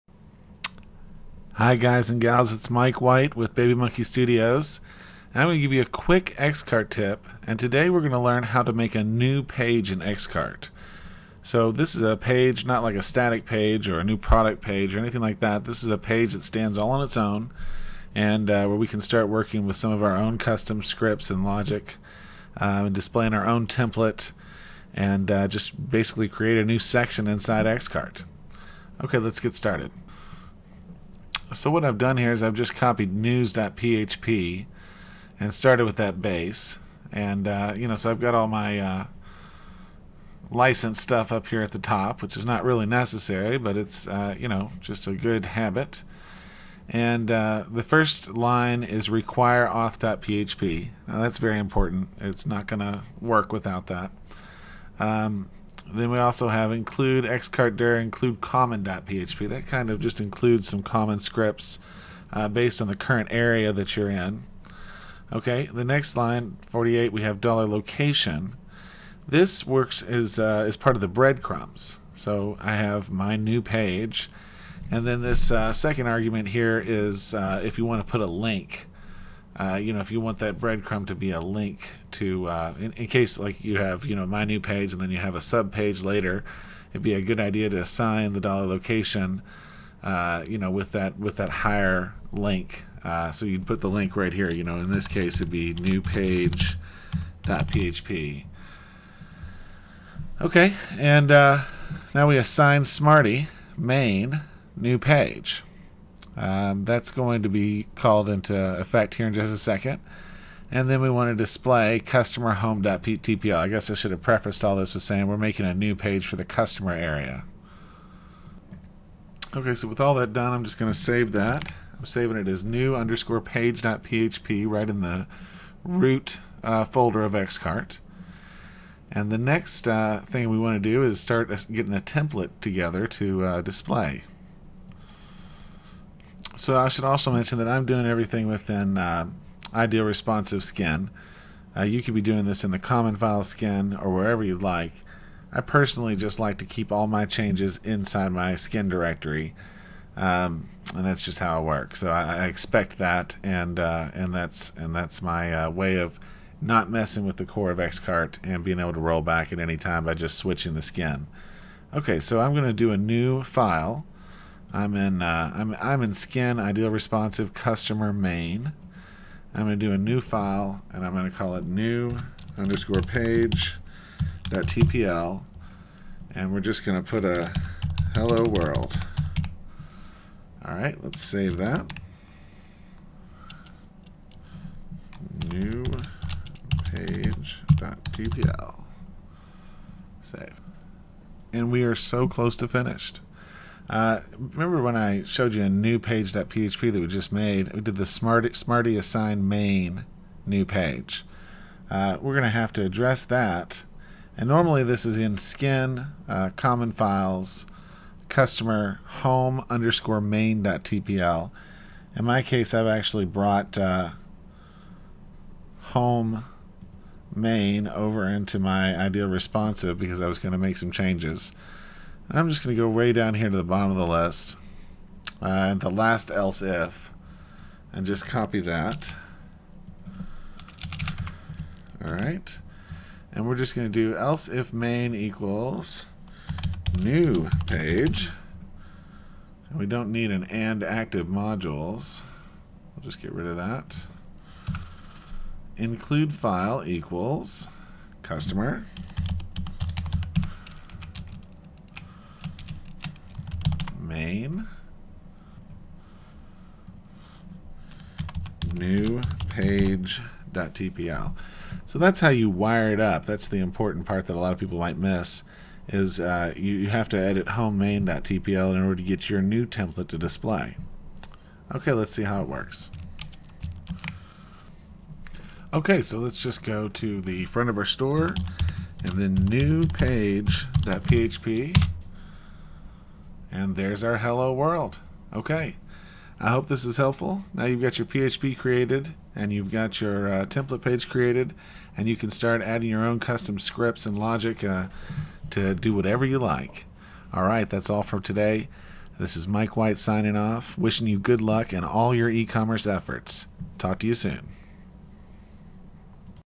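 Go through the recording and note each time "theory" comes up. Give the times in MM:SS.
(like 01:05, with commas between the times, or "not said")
not said.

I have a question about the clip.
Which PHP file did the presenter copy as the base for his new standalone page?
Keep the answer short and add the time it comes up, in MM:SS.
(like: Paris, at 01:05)
news.php, at 00:33.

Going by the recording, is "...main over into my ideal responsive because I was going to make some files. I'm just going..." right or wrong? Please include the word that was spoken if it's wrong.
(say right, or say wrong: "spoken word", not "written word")
wrong: "changes", not "files".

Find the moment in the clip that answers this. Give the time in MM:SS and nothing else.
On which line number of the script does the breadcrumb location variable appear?
01:06.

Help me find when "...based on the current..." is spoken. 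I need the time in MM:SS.
01:02.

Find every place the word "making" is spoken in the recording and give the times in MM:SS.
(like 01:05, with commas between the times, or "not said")
01:55.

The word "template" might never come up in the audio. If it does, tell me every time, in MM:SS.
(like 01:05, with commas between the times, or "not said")
00:23, 02:11, 04:29, 04:50.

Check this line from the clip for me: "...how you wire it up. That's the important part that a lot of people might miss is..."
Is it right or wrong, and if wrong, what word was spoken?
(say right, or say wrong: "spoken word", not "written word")
right.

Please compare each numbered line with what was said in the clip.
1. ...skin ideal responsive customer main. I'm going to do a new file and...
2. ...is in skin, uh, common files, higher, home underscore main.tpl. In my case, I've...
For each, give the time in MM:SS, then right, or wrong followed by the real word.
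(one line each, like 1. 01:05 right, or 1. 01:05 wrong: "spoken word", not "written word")
1. 02:46 right
2. 03:25 wrong: "customer", not "higher".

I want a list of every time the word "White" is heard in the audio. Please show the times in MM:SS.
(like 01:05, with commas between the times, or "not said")
00:03, 04:59.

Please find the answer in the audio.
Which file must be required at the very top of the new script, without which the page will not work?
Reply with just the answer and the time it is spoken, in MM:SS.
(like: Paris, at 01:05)
auth.php, at 00:49.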